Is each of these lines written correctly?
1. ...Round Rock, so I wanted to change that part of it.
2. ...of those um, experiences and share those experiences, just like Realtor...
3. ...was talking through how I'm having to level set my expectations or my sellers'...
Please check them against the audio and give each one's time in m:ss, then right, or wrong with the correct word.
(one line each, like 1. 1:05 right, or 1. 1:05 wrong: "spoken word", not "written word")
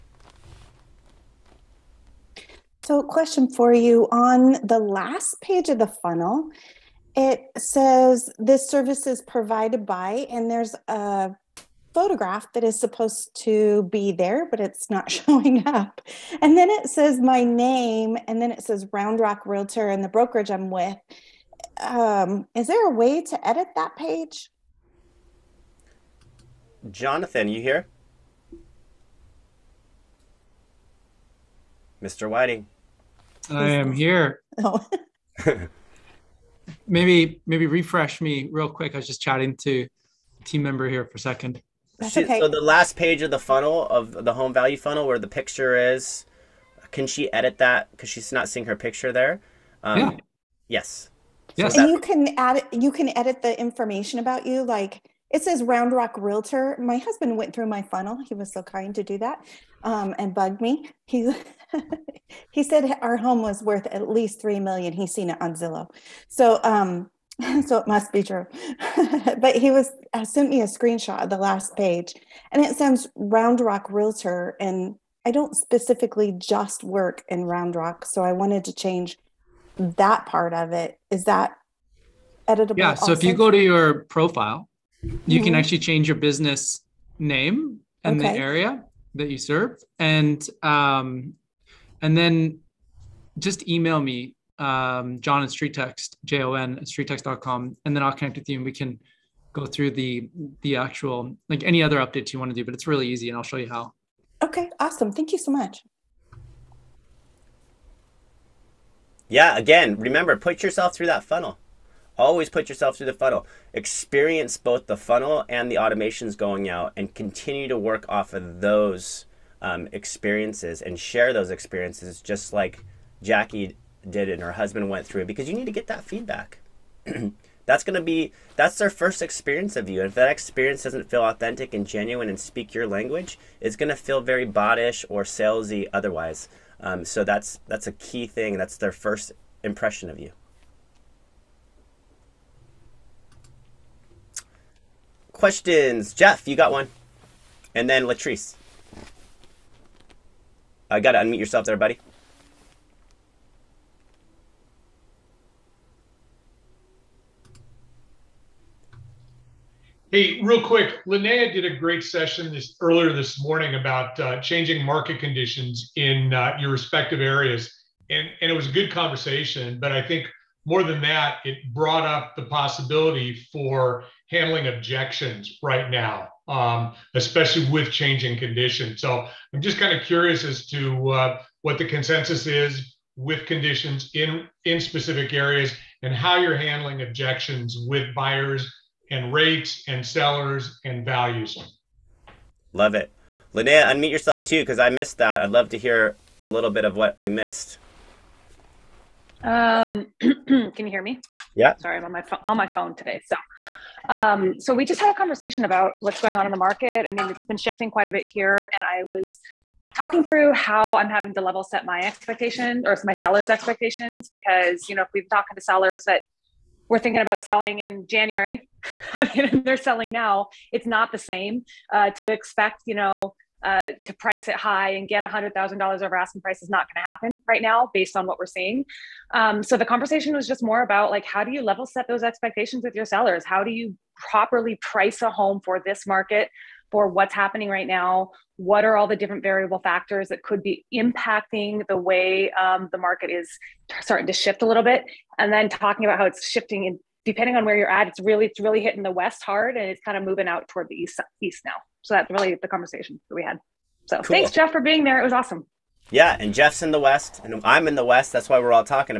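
1. 1:17 right
2. 1:58 wrong: "Jackie", not "Realtor"
3. 3:29 right.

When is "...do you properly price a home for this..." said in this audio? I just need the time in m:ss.
3:53.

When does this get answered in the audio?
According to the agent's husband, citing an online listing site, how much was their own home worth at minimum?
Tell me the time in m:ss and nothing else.
1:04.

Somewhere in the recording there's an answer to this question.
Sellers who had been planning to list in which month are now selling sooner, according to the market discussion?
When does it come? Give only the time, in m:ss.
3:38.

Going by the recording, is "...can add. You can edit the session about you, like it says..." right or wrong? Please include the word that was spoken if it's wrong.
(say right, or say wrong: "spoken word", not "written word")
wrong: "information", not "session".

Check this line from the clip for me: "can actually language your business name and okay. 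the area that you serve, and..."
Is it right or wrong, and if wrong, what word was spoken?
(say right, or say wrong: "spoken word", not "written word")
wrong: "change", not "language".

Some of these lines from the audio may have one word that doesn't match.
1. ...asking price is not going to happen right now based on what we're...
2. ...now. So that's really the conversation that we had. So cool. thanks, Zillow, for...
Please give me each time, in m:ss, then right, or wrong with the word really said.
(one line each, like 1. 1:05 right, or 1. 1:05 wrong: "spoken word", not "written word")
1. 3:46 right
2. 4:11 wrong: "Jeff", not "Zillow".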